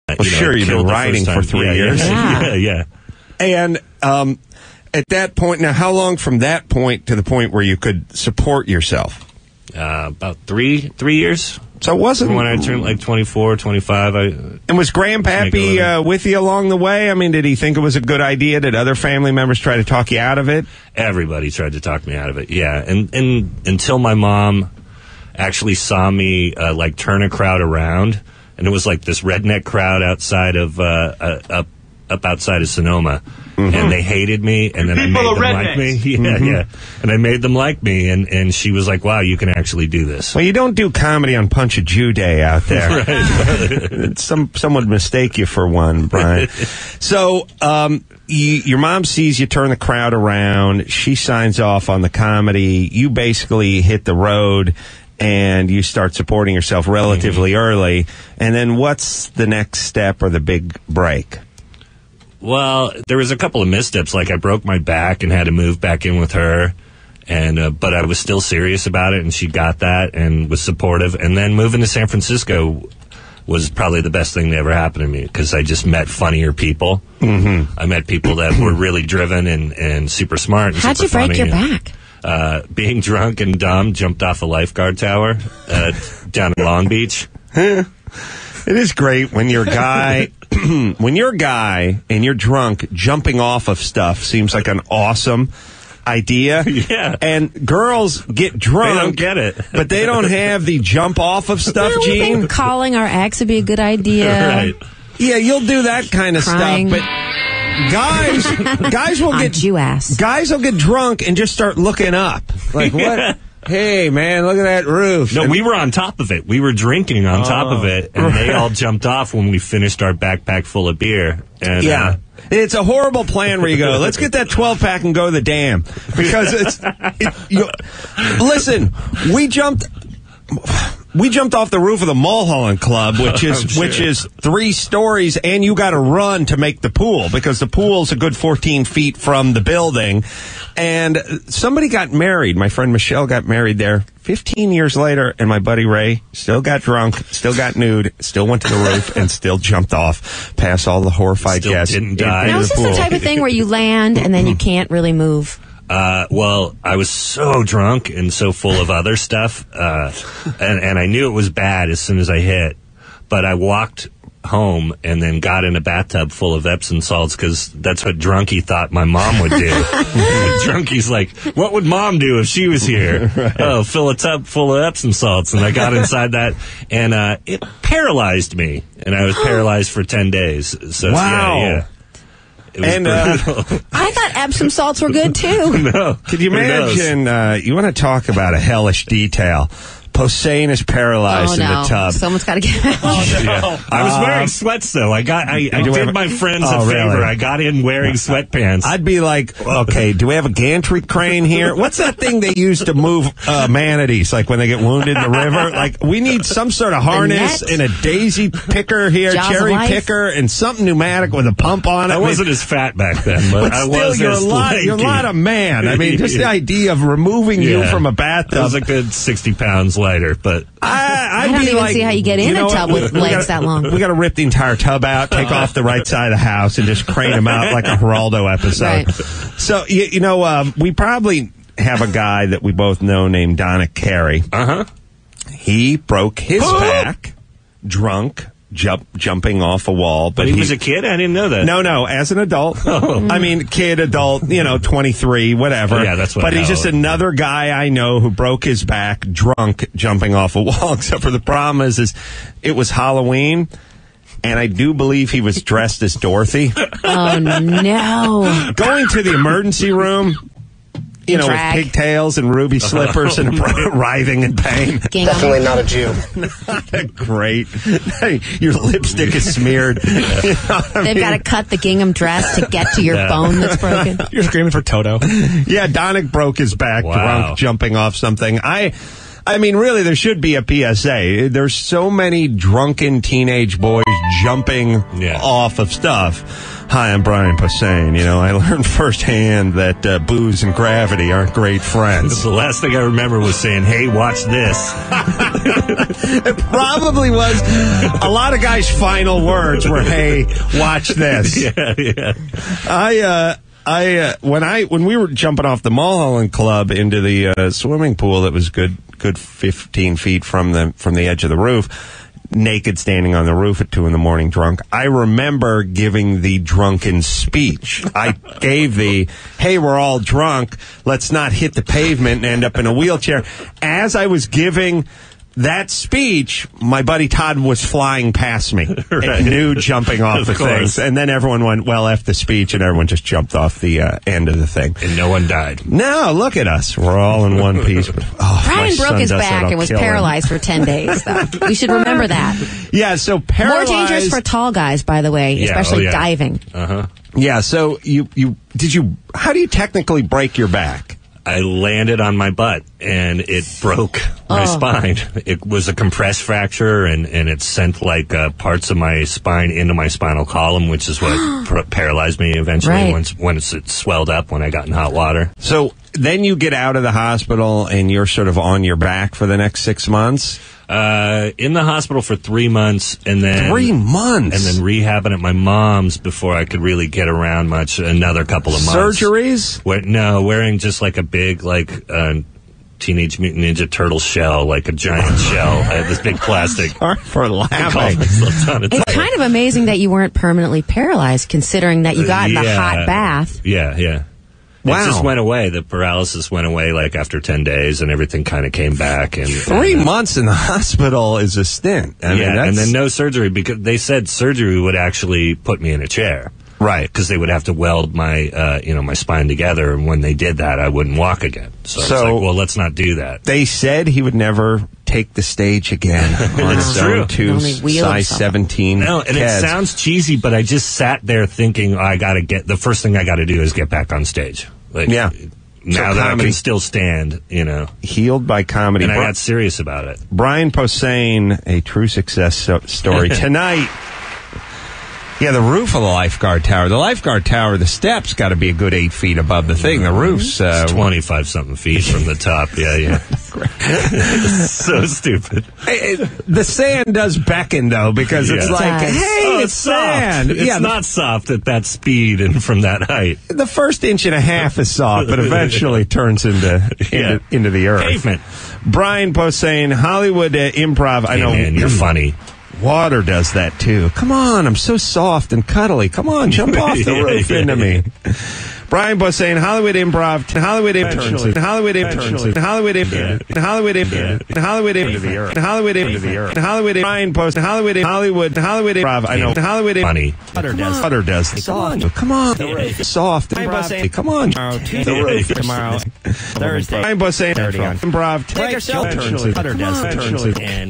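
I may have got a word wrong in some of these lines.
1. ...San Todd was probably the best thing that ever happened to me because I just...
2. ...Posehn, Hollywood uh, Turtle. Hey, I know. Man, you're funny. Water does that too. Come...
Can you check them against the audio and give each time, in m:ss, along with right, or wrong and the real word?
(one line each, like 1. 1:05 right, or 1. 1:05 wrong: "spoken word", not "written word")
1. 1:11 wrong: "Francisco", not "Todd"
2. 7:39 wrong: "Improv", not "Turtle".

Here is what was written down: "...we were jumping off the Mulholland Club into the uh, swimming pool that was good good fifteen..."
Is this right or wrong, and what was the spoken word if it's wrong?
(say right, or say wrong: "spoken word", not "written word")
right.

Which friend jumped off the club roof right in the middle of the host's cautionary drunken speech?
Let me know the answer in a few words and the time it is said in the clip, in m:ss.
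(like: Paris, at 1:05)
Todd, at 5:27.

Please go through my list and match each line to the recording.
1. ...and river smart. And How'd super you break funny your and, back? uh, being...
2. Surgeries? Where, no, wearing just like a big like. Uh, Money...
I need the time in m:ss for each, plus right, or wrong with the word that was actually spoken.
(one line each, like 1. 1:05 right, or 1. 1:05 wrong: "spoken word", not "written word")
1. 1:19 wrong: "super", not "river"
2. 6:19 wrong: "Teenage", not "Money".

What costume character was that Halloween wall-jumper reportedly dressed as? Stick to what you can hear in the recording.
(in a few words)
Dorothy.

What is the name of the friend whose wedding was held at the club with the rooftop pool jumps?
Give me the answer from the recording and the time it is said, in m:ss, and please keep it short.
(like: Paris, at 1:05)
Michelle, at 2:22.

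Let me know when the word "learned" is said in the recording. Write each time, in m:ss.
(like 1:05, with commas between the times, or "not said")
4:48.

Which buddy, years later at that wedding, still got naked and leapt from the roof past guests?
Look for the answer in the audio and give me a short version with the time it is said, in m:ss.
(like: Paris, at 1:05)
Ray, at 2:25.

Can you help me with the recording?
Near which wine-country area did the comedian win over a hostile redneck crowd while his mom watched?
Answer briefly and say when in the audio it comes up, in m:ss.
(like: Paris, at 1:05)
Sonoma, at 0:32.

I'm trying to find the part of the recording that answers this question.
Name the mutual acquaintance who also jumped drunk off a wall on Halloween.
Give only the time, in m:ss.
3:53.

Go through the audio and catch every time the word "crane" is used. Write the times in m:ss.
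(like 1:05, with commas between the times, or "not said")
3:21, 3:47.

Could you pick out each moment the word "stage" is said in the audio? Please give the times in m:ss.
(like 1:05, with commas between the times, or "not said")
6:55, 7:04.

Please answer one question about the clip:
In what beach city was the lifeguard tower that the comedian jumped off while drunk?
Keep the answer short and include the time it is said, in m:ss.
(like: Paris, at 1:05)
Long Beach, at 1:26.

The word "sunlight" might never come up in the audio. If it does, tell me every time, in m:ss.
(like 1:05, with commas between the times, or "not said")
not said.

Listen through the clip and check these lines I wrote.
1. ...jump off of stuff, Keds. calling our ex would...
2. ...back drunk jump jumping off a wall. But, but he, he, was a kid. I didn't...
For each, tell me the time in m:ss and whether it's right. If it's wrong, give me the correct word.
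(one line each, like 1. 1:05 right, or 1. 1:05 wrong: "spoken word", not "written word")
1. 1:40 wrong: "Gene", not "Keds"
2. 3:56 right.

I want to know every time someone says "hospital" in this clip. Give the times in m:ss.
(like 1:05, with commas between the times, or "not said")
6:07, 6:11, 6:40.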